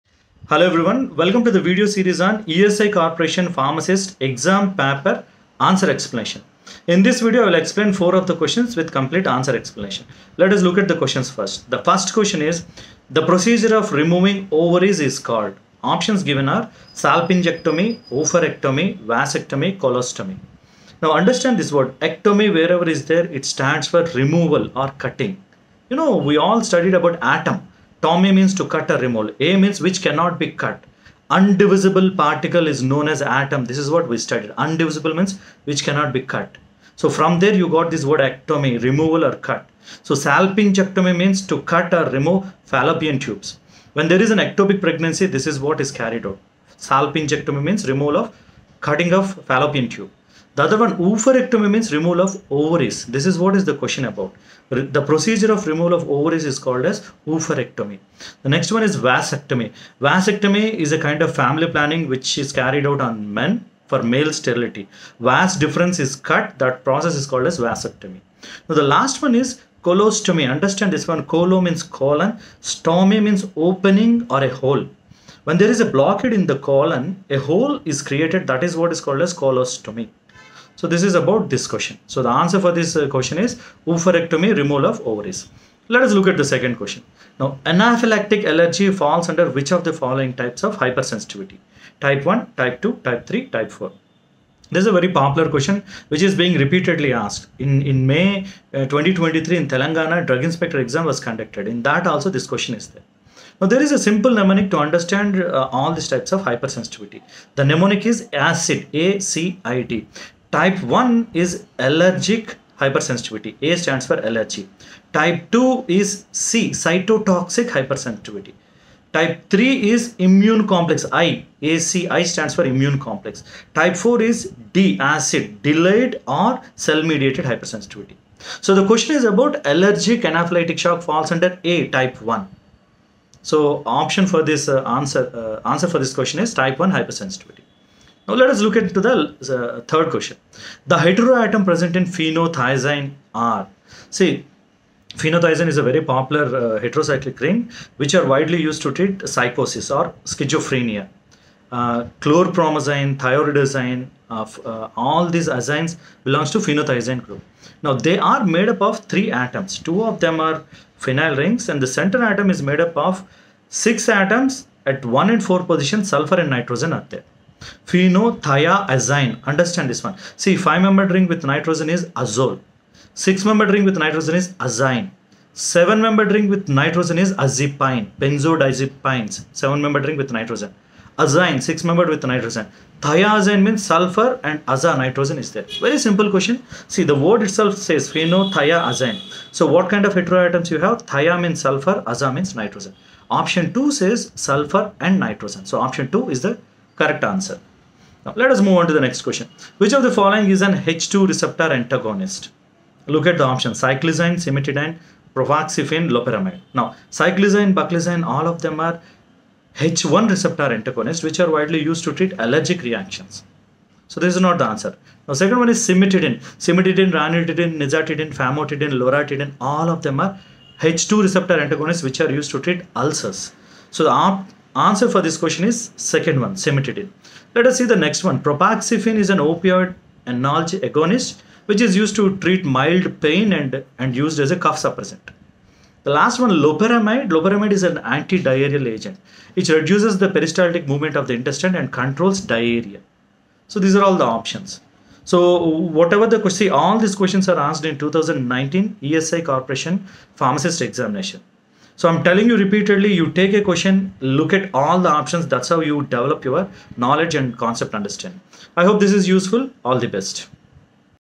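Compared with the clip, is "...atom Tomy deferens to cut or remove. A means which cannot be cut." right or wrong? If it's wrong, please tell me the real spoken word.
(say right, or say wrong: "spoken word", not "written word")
wrong: "means", not "deferens".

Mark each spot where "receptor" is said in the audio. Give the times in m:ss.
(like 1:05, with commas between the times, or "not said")
3:21, 3:30, 3:41.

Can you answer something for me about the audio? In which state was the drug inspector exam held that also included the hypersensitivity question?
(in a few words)
Telangana.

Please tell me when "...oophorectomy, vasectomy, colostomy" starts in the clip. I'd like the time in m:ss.
0:18.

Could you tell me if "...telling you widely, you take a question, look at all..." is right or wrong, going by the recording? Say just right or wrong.
wrong.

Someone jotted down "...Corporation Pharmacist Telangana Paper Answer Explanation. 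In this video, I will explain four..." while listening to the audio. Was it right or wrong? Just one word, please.
wrong.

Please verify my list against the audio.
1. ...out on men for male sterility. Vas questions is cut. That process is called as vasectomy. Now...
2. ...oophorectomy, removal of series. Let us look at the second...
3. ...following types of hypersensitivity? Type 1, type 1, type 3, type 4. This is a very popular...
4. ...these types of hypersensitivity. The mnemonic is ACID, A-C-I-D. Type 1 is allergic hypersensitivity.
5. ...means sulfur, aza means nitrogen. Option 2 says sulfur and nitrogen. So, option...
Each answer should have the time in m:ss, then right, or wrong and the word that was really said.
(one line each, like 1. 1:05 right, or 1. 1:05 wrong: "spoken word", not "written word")
1. 1:02 wrong: "deferens", not "questions"
2. 1:23 wrong: "ovaries", not "series"
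3. 1:29 wrong: "2", not "1"
4. 1:45 right
5. 3:11 right.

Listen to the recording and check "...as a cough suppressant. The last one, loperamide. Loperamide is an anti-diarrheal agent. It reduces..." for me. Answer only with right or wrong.
right.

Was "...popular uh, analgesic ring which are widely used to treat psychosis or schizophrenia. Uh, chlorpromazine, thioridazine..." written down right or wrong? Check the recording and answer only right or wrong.
wrong.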